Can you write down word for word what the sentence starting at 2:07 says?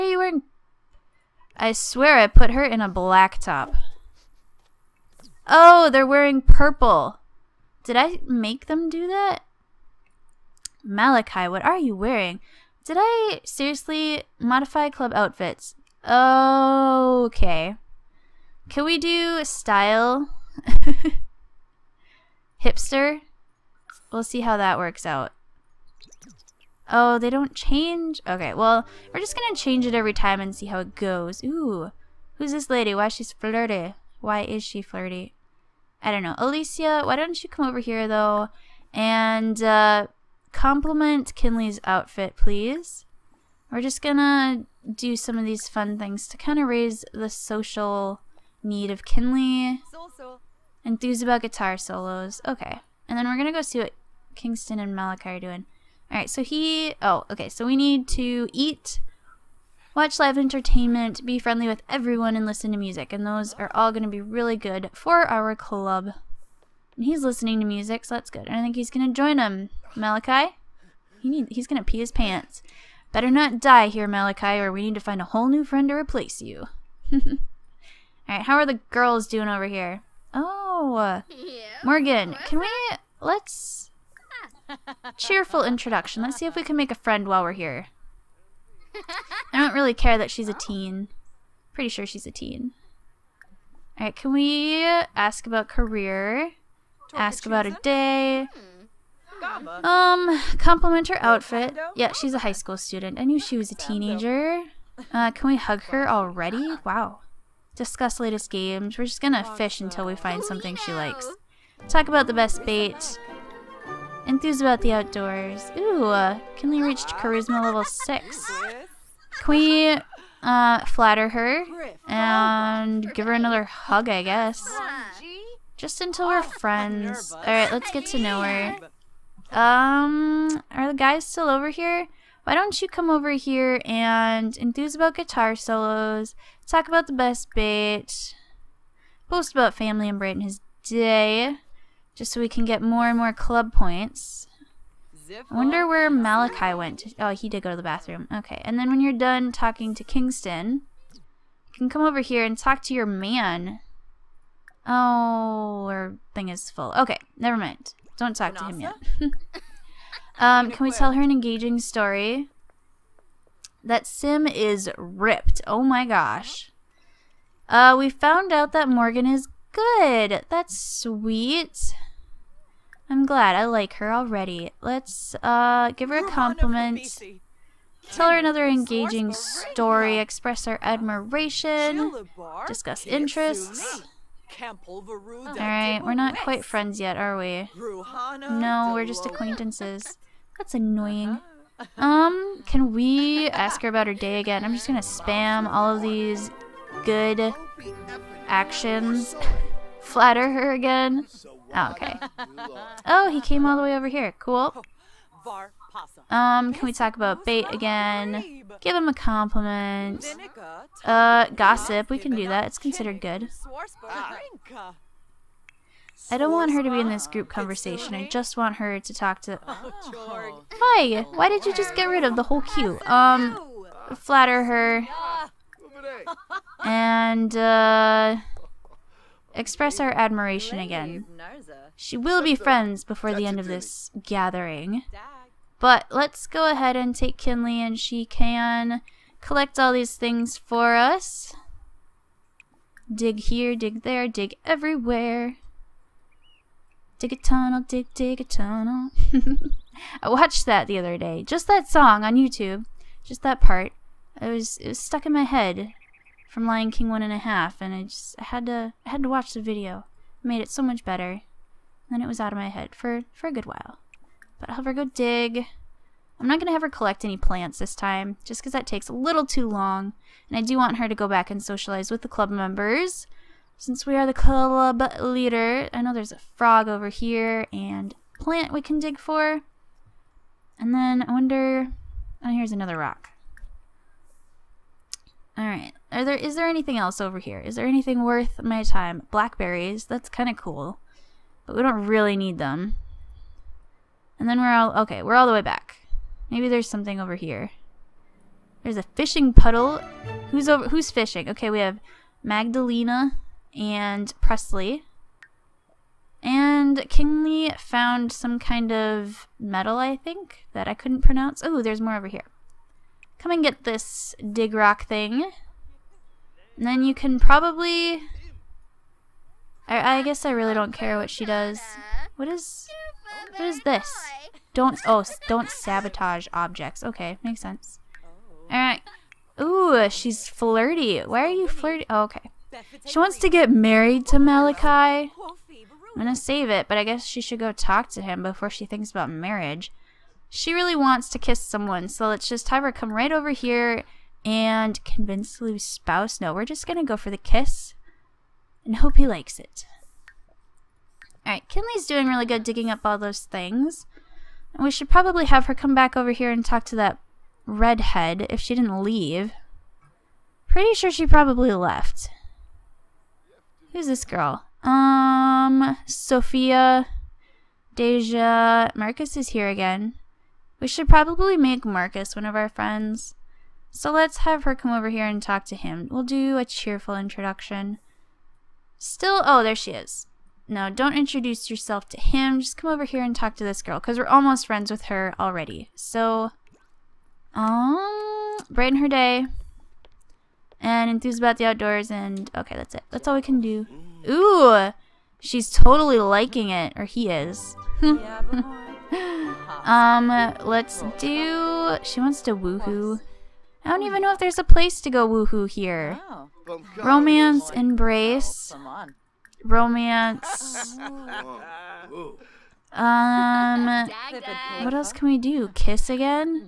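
Alright, let's get to know her.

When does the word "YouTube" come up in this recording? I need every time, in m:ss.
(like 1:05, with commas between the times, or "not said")
4:12.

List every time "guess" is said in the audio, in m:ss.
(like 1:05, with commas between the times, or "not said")
2:04, 5:20, 5:37.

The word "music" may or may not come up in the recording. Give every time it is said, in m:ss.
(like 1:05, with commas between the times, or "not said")
1:02, 1:07.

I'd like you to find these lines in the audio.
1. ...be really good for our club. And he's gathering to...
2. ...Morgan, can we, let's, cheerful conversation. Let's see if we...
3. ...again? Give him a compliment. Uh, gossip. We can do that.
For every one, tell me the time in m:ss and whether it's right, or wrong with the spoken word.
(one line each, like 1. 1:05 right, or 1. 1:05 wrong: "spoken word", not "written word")
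1. 1:04 wrong: "listening", not "gathering"
2. 1:21 wrong: "introduction", not "conversation"
3. 3:27 right.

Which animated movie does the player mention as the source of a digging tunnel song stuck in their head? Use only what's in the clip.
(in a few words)
Lion King one and a half.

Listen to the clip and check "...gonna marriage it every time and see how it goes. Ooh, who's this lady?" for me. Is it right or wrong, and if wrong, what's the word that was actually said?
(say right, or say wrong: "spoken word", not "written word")
wrong: "change", not "marriage".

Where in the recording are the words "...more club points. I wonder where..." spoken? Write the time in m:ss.
2:23.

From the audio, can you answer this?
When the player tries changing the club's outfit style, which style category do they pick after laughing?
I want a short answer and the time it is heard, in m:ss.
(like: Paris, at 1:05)
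Hipster, at 0:22.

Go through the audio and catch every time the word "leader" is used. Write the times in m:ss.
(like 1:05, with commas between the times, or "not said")
4:35.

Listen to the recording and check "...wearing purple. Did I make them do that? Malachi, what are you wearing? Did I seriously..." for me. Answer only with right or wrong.
right.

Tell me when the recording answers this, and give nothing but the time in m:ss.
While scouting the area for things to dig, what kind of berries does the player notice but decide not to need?
4:49.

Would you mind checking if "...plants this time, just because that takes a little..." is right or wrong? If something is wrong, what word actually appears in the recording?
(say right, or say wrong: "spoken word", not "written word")
right.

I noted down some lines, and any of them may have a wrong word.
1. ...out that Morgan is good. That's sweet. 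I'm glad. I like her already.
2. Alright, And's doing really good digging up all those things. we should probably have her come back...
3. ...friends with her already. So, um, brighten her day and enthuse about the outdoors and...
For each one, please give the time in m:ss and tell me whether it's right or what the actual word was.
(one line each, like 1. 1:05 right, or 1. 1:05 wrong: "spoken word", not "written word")
1. 2:48 right
2. 5:51 wrong: "Kinley", not "And"
3. 6:24 right.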